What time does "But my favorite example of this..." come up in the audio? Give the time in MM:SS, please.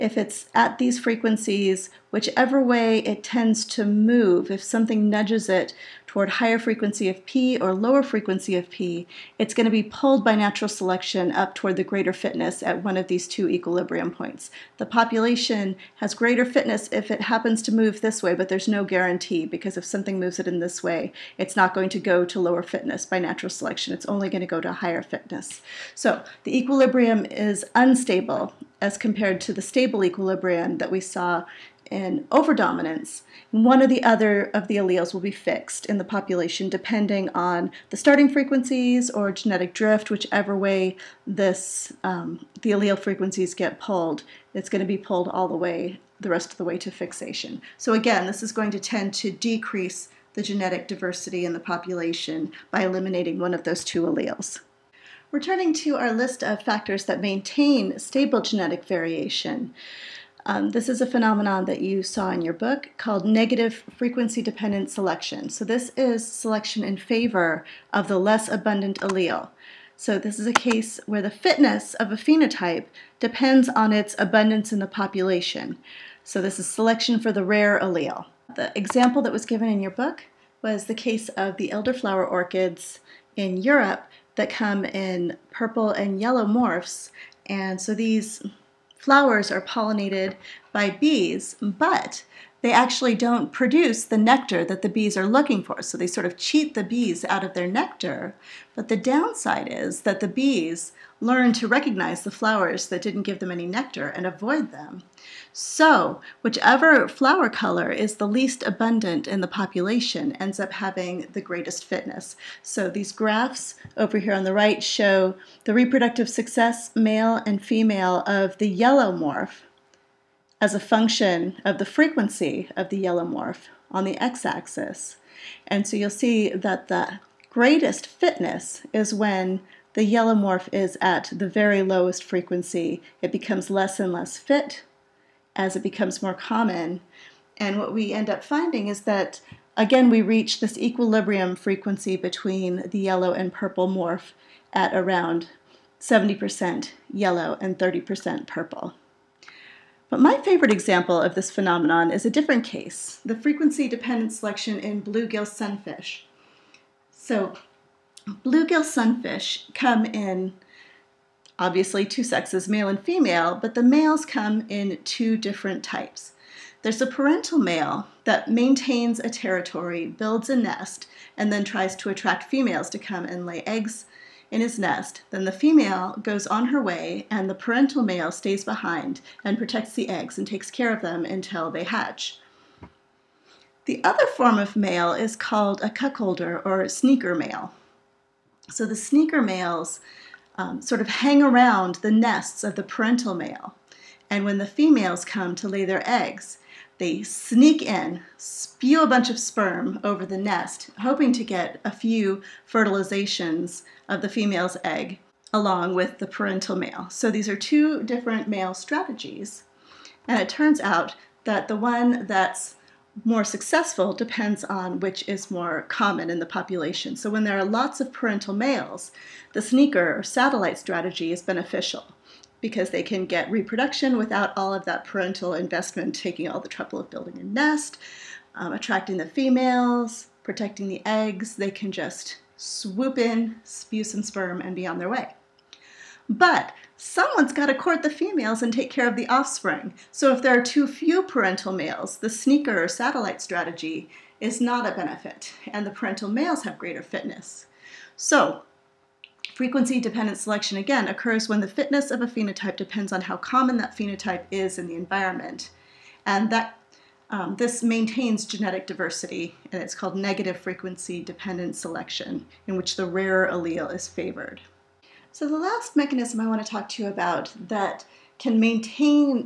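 02:30.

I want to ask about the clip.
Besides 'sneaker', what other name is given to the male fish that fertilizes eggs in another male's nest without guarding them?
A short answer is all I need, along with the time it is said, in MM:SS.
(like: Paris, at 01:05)
Cuckolder, at 03:05.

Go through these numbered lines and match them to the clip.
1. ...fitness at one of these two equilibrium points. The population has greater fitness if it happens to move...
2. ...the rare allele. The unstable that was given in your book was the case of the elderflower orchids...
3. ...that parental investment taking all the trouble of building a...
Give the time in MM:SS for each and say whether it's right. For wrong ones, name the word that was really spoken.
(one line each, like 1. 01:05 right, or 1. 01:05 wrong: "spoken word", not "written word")
1. 00:12 right
2. 01:17 wrong: "example", not "unstable"
3. 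03:44 right.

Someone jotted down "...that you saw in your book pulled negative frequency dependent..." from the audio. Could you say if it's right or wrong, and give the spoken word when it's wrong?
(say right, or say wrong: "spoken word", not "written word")
wrong: "called", not "pulled".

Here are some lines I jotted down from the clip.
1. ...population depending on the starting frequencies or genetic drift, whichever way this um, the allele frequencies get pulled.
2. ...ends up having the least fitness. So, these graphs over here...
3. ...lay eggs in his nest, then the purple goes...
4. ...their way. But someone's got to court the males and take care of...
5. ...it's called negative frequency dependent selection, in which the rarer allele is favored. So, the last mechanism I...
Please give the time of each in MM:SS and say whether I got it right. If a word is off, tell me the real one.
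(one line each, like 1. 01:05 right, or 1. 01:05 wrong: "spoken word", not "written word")
1. 00:36 right
2. 01:50 wrong: "greatest", not "least"
3. 02:53 wrong: "female", not "purple"
4. 03:54 wrong: "females", not "males"
5. 04:19 right.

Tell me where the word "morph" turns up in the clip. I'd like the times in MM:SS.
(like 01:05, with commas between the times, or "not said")
01:26, 01:59, 02:03, 02:10, 02:23.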